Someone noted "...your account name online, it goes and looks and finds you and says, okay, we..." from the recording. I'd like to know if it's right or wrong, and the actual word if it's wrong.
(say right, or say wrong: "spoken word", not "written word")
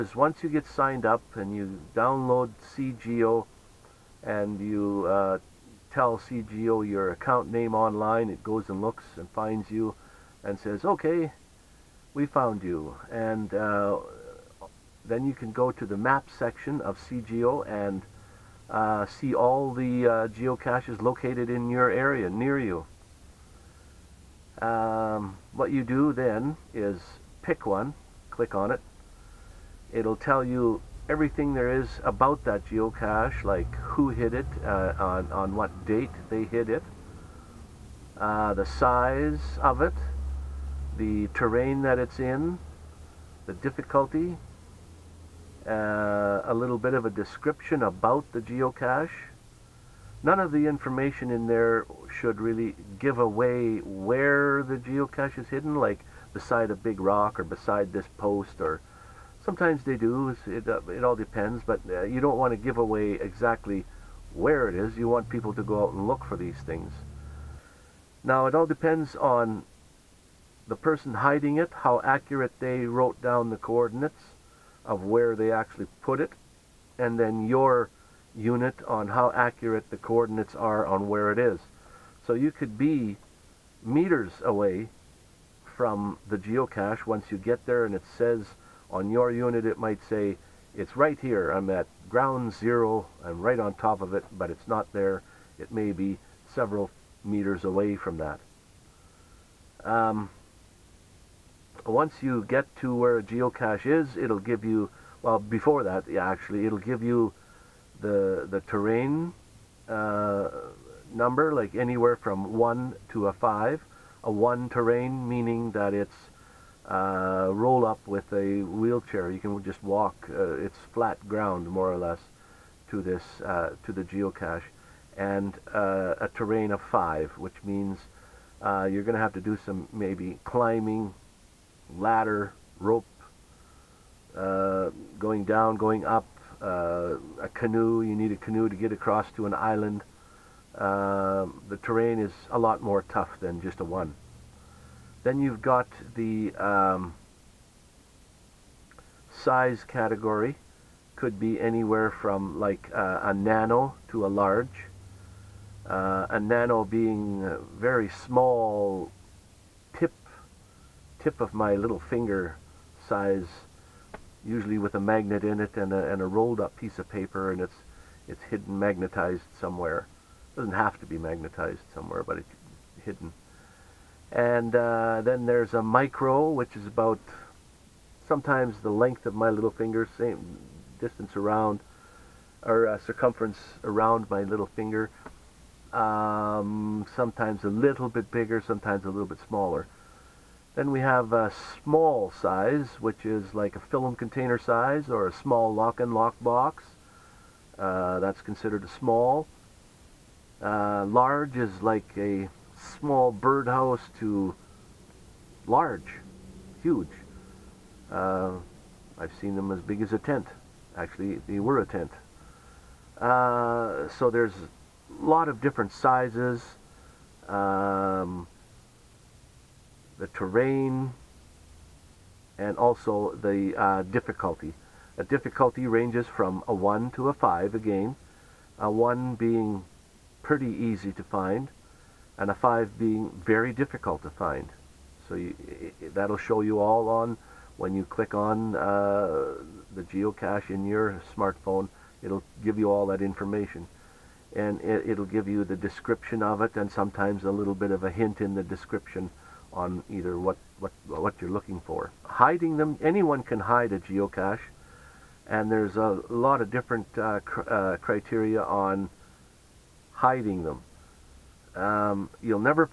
right.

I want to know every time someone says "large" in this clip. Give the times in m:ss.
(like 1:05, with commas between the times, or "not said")
2:34, 3:21, 3:25.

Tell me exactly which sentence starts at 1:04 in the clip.
You want people to go out and look for these things.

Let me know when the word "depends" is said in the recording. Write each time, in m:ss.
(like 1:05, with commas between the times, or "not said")
1:01, 1:08.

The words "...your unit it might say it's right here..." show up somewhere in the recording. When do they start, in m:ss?
1:29.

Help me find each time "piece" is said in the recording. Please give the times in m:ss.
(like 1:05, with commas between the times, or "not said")
2:46.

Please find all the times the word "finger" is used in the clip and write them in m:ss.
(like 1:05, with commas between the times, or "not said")
2:41, 2:59, 3:04.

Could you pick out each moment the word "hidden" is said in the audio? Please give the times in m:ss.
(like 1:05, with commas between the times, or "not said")
0:55, 2:48, 2:53.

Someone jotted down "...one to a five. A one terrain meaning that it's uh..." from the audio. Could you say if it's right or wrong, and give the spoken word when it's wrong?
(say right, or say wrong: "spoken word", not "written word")
right.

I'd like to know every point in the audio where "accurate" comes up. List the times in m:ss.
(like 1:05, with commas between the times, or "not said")
1:12, 1:19.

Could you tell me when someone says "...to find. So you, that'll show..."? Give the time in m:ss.
3:54.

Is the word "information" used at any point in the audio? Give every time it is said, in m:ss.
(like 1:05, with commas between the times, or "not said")
0:50, 4:03.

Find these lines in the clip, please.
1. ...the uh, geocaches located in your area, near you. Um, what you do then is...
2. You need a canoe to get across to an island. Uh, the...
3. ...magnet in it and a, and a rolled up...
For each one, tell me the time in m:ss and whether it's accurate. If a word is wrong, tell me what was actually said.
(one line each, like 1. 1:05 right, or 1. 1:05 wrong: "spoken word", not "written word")
1. 0:19 right
2. 2:18 right
3. 2:45 right.